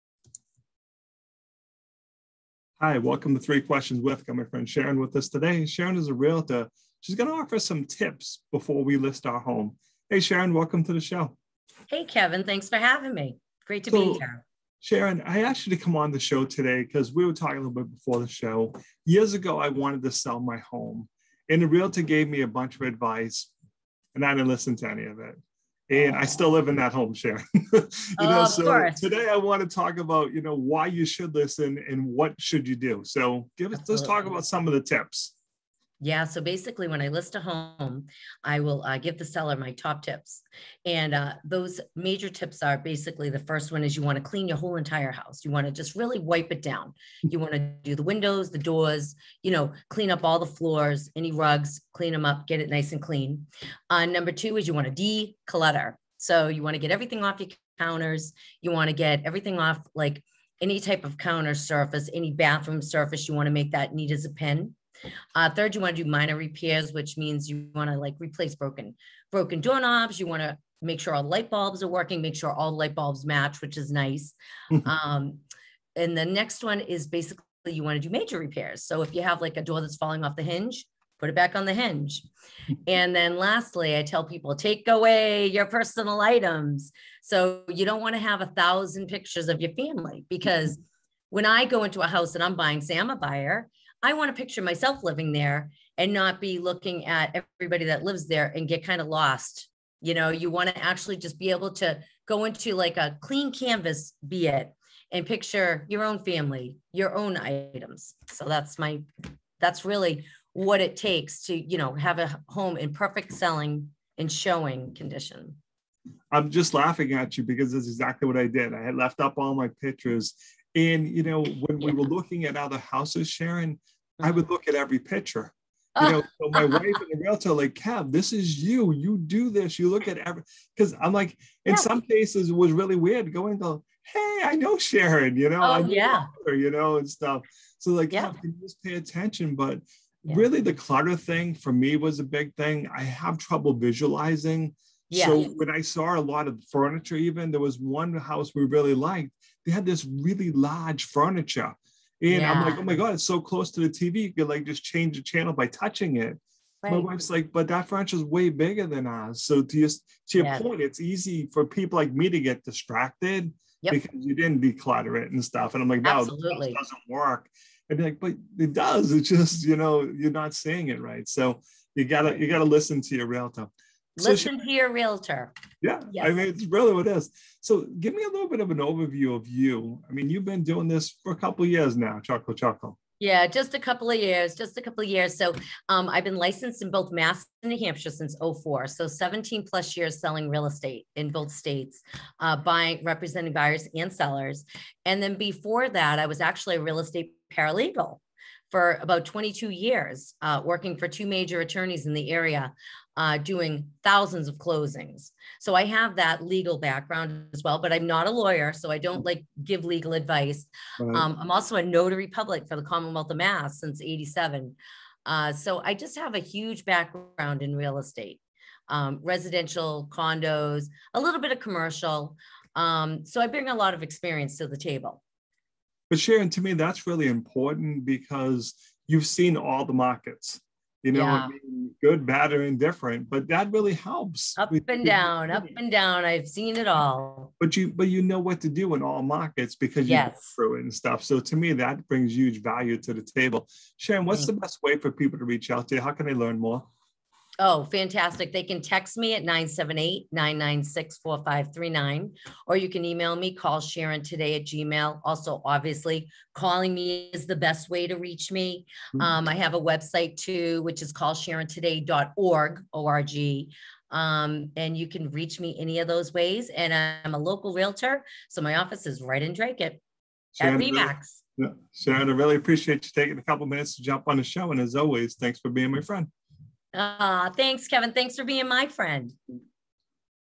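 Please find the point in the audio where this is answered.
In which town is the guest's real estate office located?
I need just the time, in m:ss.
4:29.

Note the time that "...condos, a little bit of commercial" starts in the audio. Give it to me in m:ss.
3:40.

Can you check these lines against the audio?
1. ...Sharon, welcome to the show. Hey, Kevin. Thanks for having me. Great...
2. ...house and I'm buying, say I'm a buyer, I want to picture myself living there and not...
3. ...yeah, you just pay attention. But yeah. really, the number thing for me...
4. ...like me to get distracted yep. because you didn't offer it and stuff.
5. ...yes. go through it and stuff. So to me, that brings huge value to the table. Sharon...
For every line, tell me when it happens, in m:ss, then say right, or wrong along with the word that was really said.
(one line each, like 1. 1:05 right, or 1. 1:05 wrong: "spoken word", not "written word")
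1. 0:10 right
2. 1:32 right
3. 2:18 wrong: "clutter", not "number"
4. 2:41 wrong: "declutter", not "offer"
5. 4:00 right.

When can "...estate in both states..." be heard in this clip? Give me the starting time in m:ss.
3:10.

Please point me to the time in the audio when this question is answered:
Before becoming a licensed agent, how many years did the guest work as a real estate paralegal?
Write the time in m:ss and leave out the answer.
3:19.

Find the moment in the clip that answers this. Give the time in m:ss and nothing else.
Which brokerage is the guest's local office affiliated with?
4:30.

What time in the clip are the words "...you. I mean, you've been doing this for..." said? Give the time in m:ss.
2:59.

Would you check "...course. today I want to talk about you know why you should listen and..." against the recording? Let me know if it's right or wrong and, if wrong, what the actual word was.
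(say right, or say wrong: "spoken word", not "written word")
right.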